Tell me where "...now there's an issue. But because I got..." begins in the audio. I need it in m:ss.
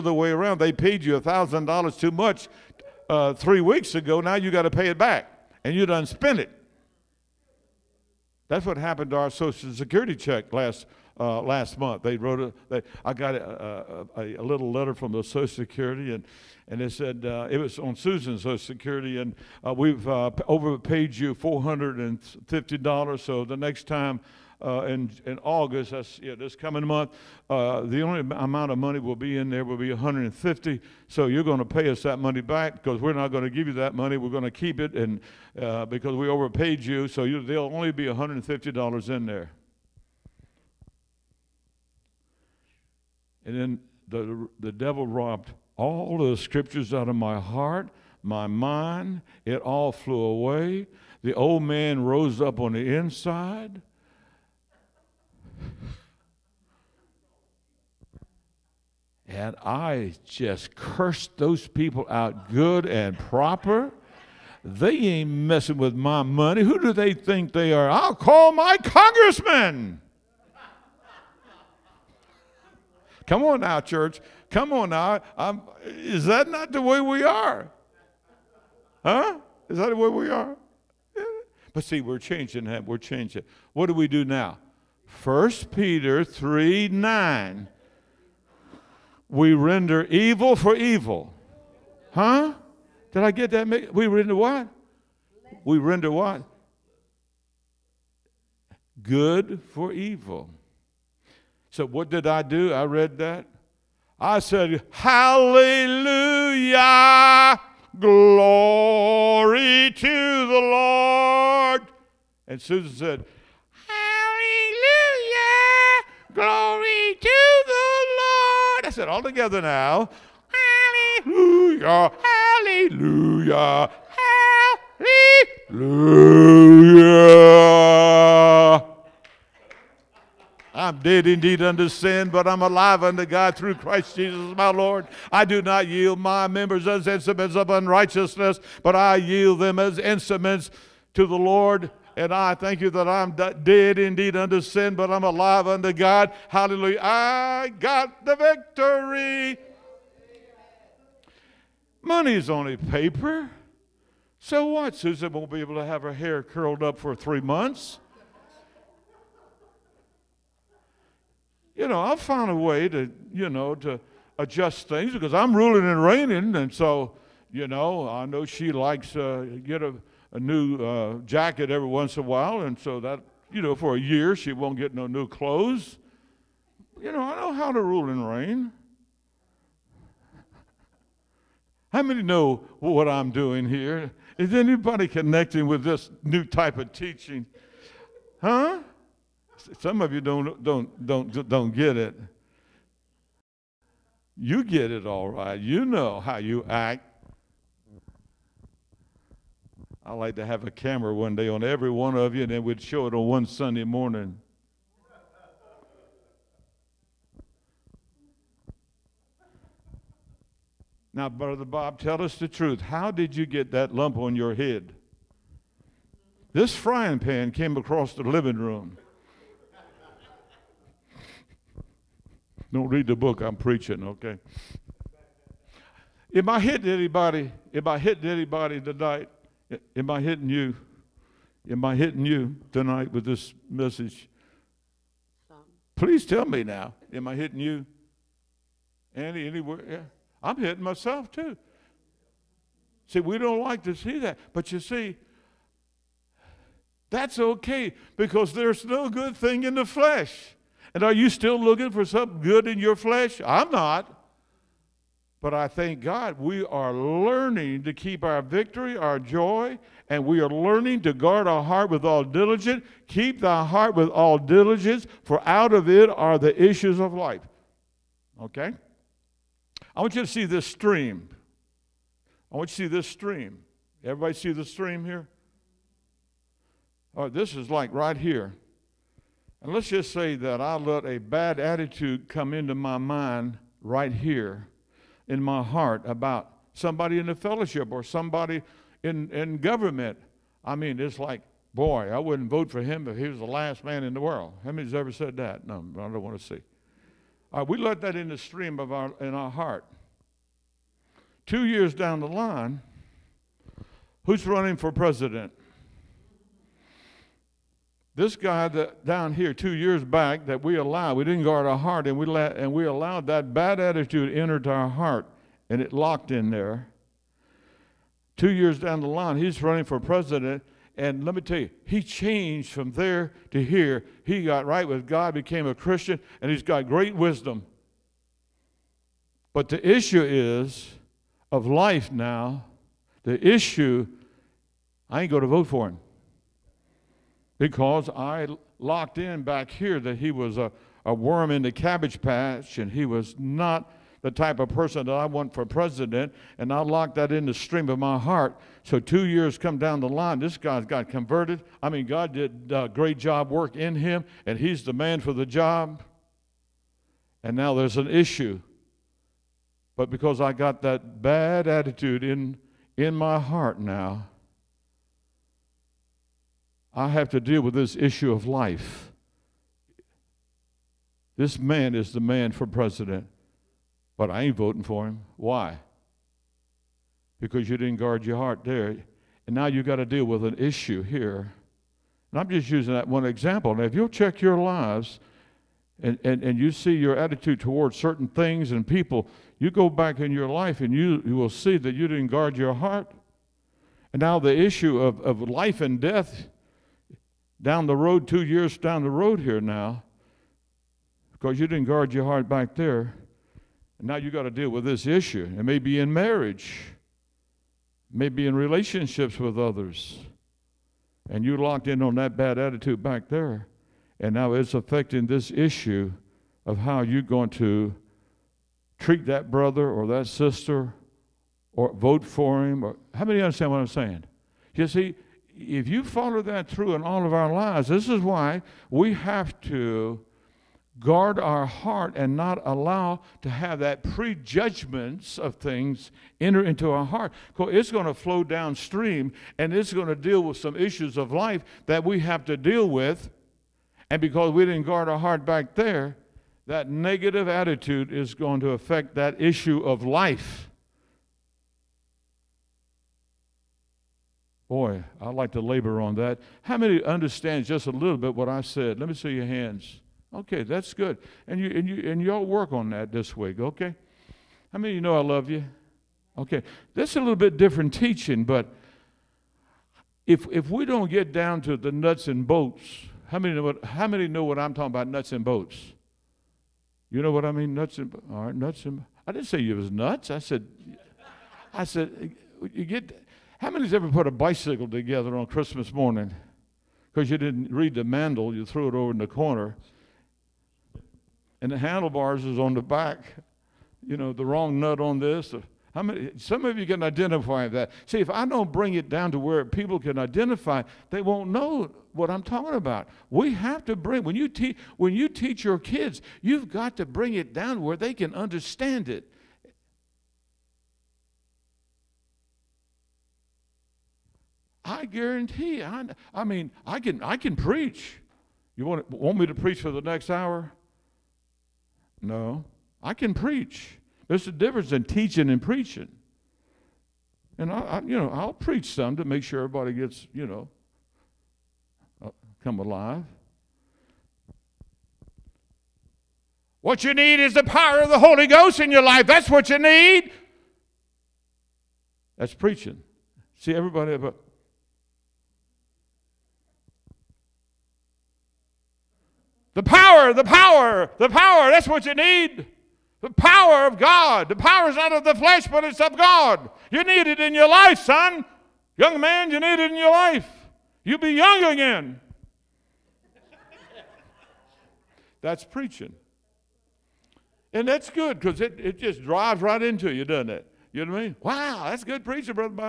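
5:57.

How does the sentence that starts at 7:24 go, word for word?
And because we didn't guard our heart back there, that negative attitude is going to affect that issue of life.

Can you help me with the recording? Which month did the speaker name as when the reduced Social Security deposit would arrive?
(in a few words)
August.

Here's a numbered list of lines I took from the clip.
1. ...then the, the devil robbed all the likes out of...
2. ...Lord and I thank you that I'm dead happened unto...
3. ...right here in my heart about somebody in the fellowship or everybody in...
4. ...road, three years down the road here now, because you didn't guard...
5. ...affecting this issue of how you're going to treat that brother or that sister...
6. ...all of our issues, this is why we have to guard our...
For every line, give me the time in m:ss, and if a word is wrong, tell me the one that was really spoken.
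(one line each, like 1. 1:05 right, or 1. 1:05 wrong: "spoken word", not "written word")
1. 0:43 wrong: "scriptures", not "likes"
2. 2:21 wrong: "indeed", not "happened"
3. 4:43 wrong: "somebody", not "everybody"
4. 6:37 wrong: "two", not "three"
5. 6:54 right
6. 7:07 wrong: "lives", not "issues".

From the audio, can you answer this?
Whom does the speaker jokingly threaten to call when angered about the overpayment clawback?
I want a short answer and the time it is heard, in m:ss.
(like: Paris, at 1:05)
My congressman, at 1:08.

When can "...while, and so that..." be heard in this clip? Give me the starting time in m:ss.
2:52.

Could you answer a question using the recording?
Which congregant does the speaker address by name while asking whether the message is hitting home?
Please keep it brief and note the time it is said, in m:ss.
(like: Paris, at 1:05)
Andy, at 3:59.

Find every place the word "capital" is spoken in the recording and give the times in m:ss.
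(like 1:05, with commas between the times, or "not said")
not said.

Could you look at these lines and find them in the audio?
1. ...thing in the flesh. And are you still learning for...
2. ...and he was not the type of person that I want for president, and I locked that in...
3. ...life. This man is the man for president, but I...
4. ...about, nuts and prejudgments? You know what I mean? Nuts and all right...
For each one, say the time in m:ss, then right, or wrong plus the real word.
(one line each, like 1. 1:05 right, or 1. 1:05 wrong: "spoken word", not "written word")
1. 4:09 wrong: "looking", not "learning"
2. 5:42 right
3. 6:08 right
4. 7:54 wrong: "bolts", not "prejudgments".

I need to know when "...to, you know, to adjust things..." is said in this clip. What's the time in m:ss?
2:42.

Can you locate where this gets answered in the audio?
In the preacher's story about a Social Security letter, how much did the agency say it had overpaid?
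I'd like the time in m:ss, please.
0:21.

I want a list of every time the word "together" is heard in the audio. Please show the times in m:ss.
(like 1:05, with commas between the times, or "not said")
1:59, 8:04.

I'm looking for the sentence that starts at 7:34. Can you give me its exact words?
Boy, I'd like to labor on that.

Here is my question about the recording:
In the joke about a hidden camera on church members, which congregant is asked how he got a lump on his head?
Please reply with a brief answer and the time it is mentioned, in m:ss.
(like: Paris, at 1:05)
Brother Bob, at 3:31.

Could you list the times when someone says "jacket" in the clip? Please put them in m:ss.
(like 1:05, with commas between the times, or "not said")
2:51.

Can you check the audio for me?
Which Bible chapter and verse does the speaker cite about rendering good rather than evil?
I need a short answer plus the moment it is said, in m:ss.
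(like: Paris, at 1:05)
1 Peter 3:9, at 1:25.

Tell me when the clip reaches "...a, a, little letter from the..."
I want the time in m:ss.
0:14.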